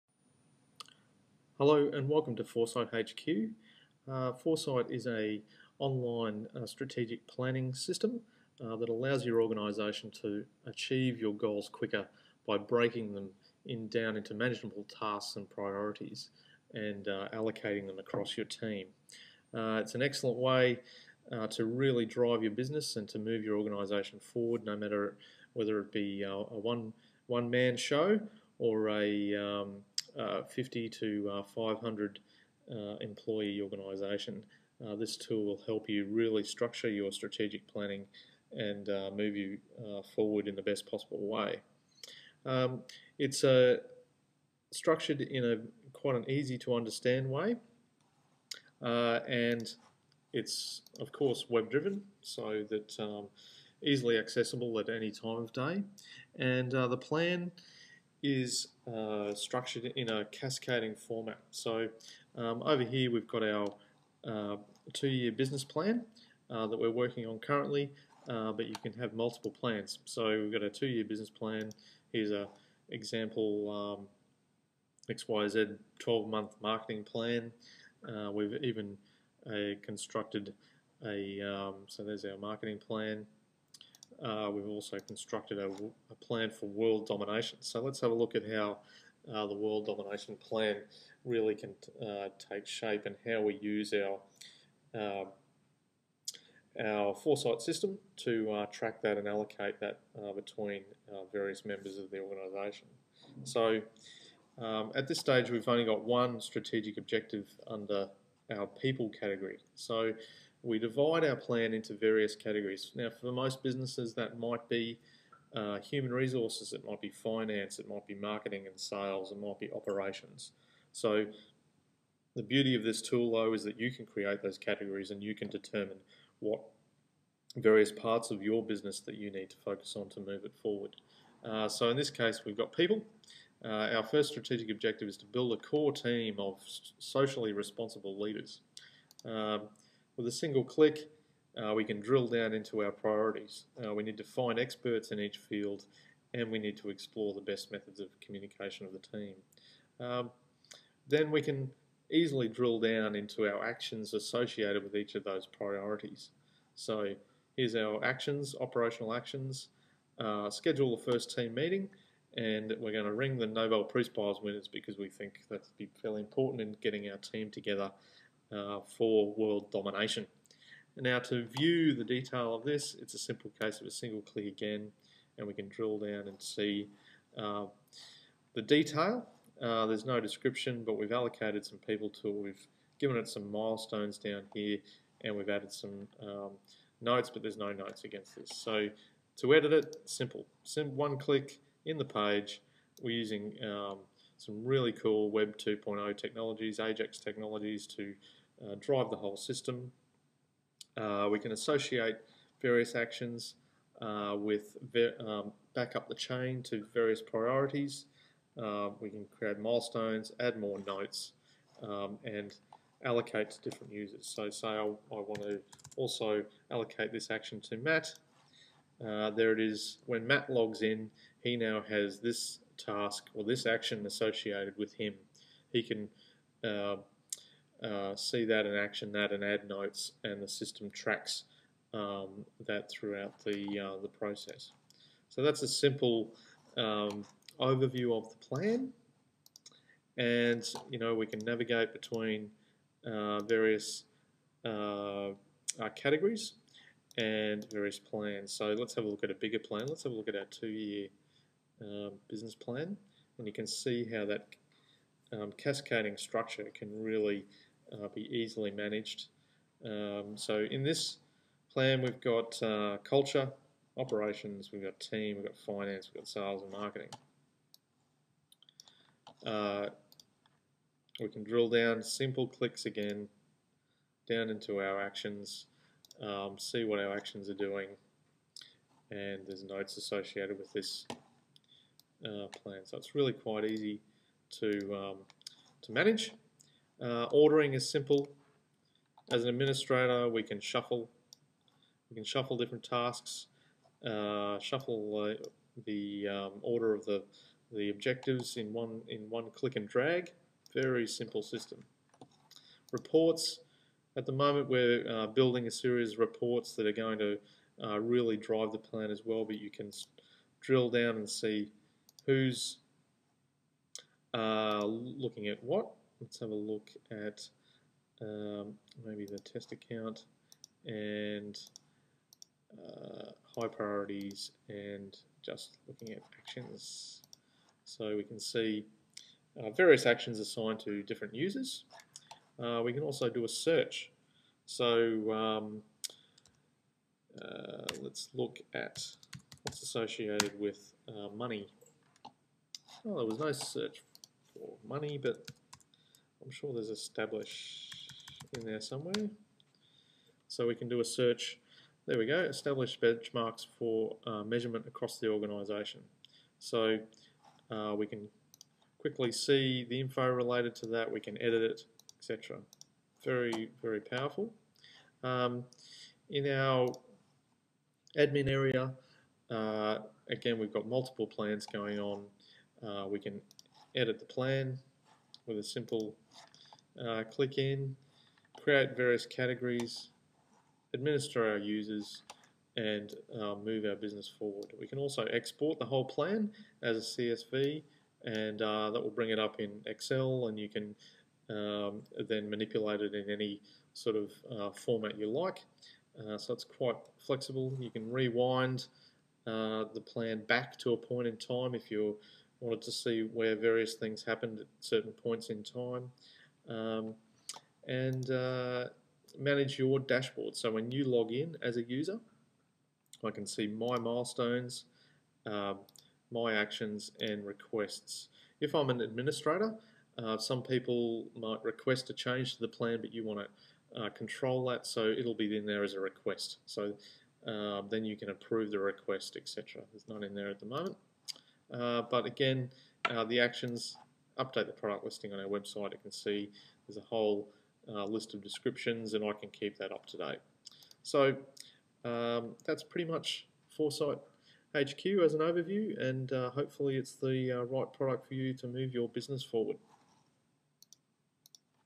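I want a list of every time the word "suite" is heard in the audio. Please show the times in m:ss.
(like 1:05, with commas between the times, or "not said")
not said.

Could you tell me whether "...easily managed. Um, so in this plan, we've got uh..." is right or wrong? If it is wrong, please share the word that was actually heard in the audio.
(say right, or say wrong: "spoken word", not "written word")
right.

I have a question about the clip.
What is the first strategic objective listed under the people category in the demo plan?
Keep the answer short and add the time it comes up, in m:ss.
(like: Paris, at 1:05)
Build a core team of socially responsible leaders, at 2:15.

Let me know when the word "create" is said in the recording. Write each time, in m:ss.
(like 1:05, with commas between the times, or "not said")
2:04, 3:29, 6:18.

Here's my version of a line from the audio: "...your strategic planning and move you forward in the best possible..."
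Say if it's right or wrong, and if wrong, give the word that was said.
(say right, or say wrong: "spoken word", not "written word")
right.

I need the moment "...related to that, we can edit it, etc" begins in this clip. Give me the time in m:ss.
6:00.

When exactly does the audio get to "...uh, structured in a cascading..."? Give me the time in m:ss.
0:58.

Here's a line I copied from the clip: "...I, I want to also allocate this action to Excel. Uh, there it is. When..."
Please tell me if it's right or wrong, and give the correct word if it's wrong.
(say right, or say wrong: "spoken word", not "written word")
wrong: "Matt", not "Excel".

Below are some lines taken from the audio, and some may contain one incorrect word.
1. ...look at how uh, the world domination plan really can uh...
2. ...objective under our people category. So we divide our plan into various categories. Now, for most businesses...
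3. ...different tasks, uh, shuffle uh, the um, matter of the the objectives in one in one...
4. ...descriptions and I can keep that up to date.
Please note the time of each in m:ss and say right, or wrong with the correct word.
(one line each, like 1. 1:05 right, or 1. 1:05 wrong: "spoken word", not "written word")
1. 1:28 right
2. 1:46 right
3. 4:52 wrong: "order", not "matter"
4. 7:18 right.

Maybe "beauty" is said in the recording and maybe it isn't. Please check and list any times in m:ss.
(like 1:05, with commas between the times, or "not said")
2:02.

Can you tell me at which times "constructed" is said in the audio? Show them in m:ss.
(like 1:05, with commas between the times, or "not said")
1:19, 1:24.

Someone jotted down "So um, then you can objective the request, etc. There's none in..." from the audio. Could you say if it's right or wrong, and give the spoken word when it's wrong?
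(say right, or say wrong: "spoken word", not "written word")
wrong: "approve", not "objective".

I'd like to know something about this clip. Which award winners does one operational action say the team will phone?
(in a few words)
Nobel Peace Prize.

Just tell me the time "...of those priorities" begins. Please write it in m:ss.
2:35.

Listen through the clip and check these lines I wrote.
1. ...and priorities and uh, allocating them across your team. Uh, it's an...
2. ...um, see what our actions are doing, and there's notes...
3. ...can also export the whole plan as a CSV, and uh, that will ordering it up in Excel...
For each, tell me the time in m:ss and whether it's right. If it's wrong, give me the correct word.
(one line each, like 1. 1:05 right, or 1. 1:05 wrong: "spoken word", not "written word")
1. 0:15 right
2. 4:36 right
3. 6:24 wrong: "bring", not "ordering".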